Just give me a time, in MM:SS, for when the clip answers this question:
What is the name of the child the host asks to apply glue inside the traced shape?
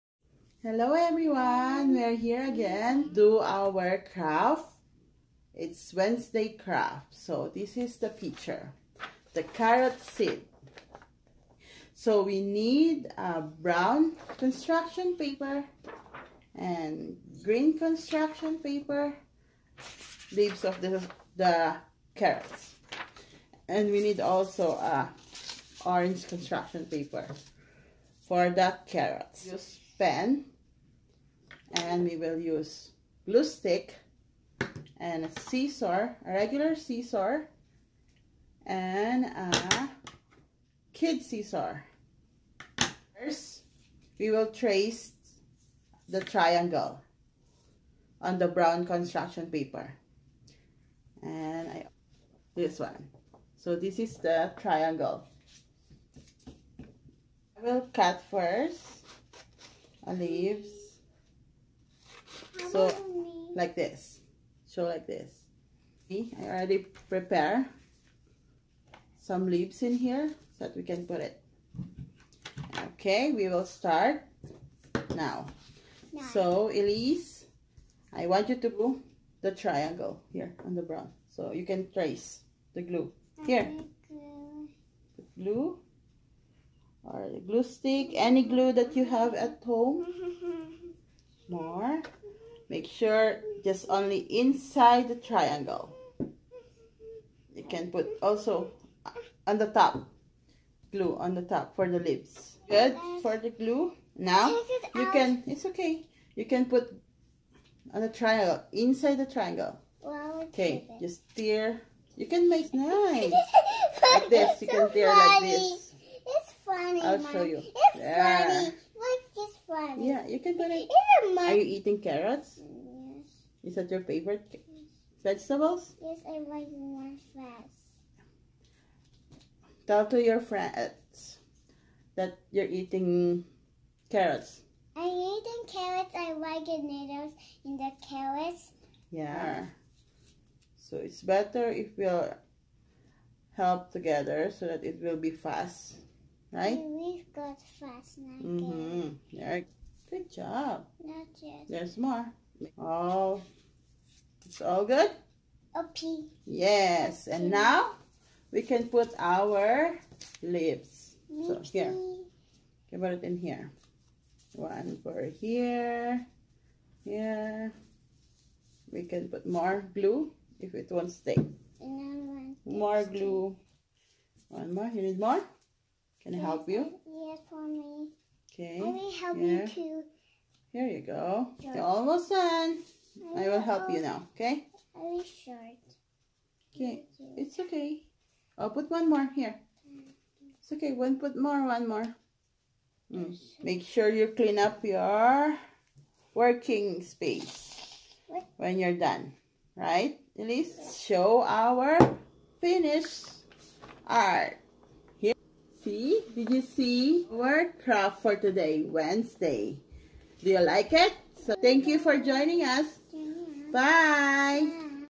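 01:16.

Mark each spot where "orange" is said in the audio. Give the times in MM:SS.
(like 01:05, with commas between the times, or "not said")
00:25.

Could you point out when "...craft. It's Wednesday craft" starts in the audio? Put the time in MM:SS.
00:04.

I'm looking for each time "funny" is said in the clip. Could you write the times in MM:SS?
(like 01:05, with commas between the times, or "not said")
01:58.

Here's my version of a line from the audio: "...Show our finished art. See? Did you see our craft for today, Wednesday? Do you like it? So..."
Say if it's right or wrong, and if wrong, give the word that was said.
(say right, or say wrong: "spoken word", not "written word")
right.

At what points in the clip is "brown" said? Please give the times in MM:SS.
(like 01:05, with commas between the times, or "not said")
00:13, 00:48, 01:20.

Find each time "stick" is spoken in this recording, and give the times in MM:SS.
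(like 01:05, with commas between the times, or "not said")
00:33, 01:27.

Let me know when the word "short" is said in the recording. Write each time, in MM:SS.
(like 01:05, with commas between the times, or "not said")
03:05.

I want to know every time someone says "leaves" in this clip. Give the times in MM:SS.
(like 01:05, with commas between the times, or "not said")
00:20, 01:00, 01:09, 02:40.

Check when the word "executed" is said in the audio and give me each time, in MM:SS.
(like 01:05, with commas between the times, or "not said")
not said.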